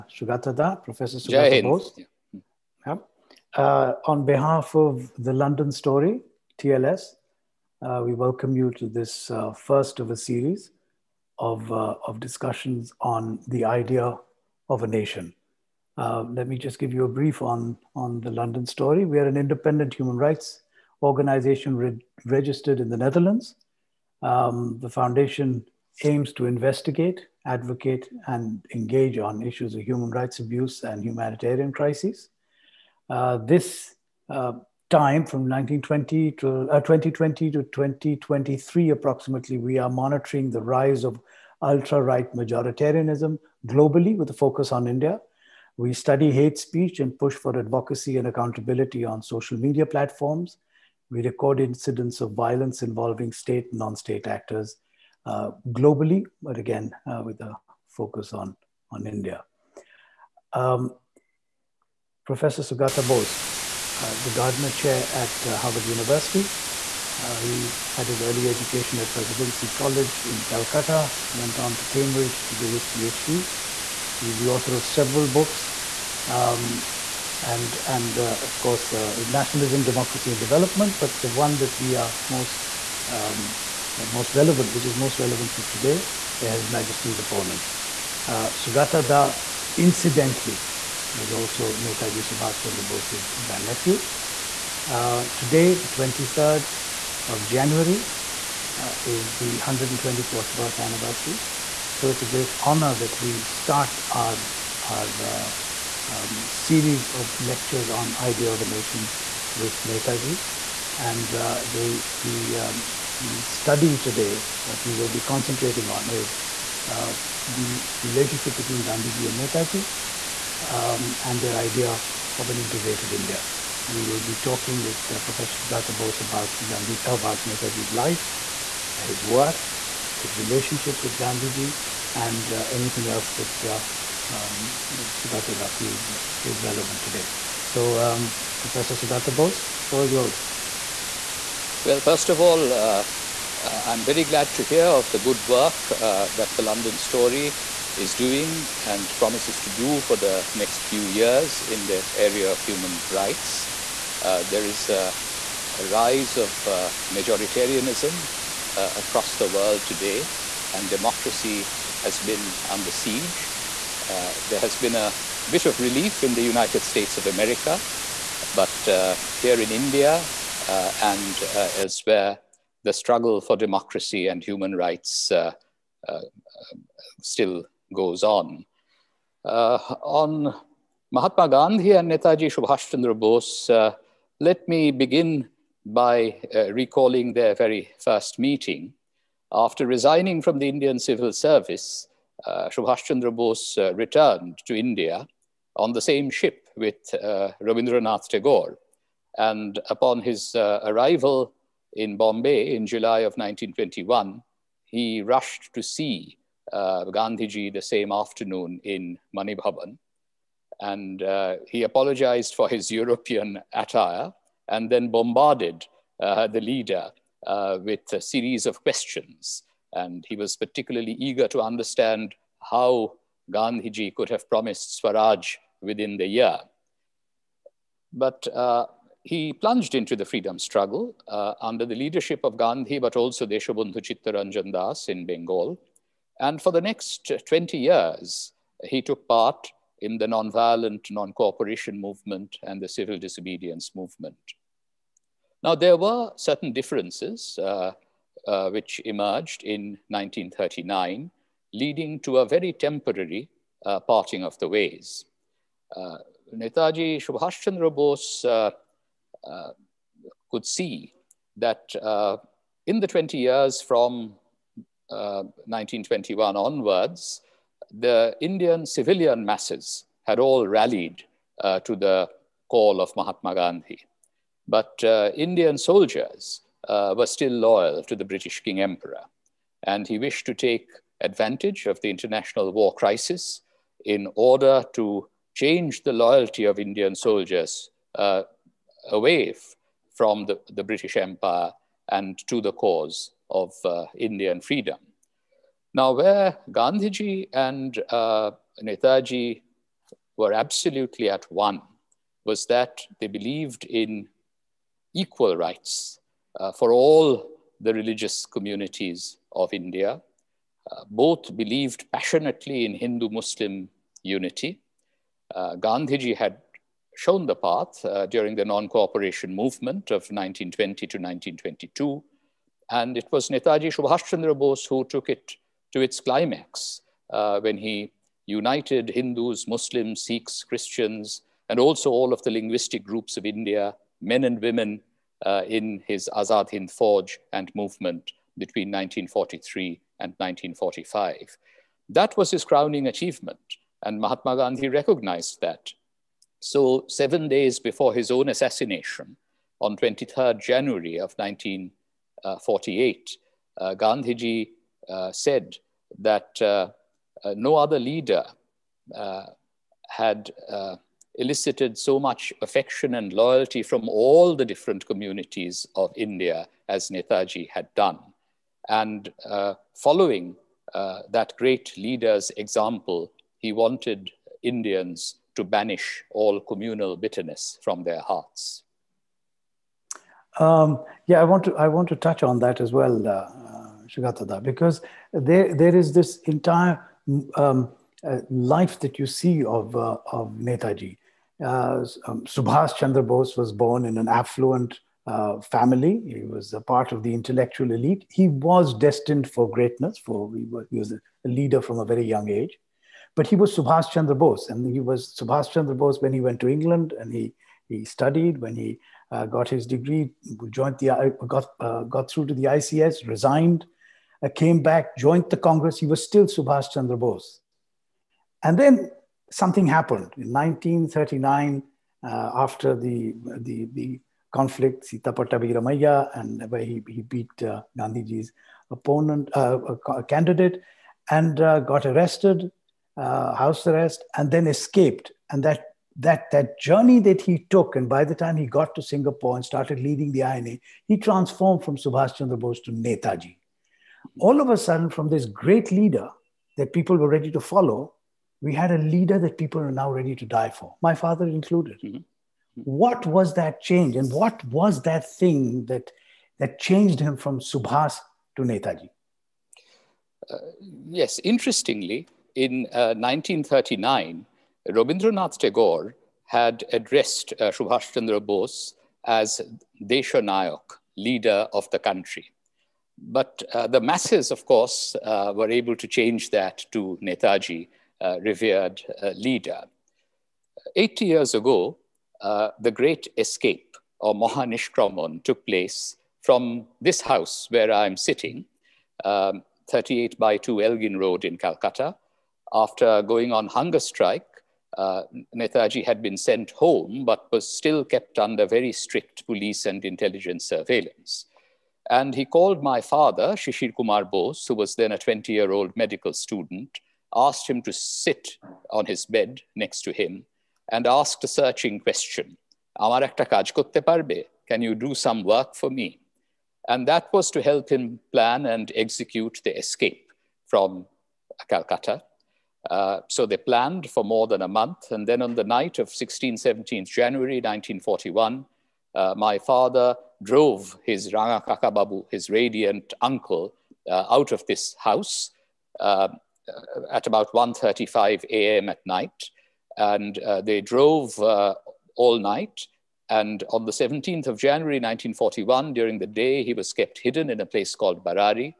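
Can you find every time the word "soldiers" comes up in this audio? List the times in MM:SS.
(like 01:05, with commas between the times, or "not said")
04:35, 04:47.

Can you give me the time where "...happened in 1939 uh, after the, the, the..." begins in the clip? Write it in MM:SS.
06:59.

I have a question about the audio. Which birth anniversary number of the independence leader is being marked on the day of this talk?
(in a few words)
124th.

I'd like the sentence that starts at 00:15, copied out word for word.
Uh, let me just give you a brief on, on the London Story.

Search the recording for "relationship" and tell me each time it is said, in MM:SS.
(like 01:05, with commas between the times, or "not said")
01:58, 02:10.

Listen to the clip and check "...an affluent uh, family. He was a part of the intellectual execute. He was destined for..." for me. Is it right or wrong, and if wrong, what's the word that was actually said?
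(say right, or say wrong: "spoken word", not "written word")
wrong: "elite", not "execute".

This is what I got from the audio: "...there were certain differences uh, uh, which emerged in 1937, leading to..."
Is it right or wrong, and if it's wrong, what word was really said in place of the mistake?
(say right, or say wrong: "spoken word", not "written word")
wrong: "1939", not "1937".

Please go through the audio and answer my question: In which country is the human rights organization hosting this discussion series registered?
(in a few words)
the Netherlands.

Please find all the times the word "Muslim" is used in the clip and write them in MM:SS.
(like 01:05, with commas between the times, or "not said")
05:13, 05:29.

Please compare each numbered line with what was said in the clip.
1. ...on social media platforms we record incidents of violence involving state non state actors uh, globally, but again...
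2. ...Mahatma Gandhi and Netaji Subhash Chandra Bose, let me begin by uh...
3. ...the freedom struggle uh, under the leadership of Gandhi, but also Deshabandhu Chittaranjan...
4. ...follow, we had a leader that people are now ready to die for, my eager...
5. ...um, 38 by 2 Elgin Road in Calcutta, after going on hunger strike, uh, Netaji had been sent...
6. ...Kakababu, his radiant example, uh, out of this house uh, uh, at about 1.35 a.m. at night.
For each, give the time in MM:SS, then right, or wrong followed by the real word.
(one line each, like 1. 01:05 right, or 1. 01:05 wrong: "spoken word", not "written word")
1. 00:49 right
2. 03:01 right
3. 03:50 right
4. 07:27 wrong: "father", not "eager"
5. 08:09 right
6. 08:51 wrong: "uncle", not "example".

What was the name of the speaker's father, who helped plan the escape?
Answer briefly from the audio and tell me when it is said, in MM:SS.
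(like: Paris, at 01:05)
Shishir Kumar Bose, at 08:23.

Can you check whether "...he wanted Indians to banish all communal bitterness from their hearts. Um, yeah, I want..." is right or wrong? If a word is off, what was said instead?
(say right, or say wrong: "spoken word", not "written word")
right.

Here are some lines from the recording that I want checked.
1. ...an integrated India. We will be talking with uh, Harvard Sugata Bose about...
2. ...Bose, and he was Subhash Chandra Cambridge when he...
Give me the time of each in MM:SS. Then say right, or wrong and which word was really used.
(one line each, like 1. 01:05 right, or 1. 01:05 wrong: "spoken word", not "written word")
1. 02:02 wrong: "Professor", not "Harvard"
2. 06:44 wrong: "Bose", not "Cambridge".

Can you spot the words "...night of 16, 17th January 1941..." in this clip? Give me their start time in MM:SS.
08:45.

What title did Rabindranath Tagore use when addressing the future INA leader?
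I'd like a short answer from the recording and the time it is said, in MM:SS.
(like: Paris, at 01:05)
Deshanayak, at 07:50.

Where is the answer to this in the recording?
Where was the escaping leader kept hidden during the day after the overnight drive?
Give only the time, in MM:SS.
09:08.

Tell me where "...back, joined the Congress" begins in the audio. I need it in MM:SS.
06:54.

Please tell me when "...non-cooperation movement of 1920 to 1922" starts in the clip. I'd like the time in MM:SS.
05:18.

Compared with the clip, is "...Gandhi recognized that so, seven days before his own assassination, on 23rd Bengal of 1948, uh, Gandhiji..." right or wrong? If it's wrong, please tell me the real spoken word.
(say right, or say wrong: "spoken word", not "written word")
wrong: "January", not "Bengal".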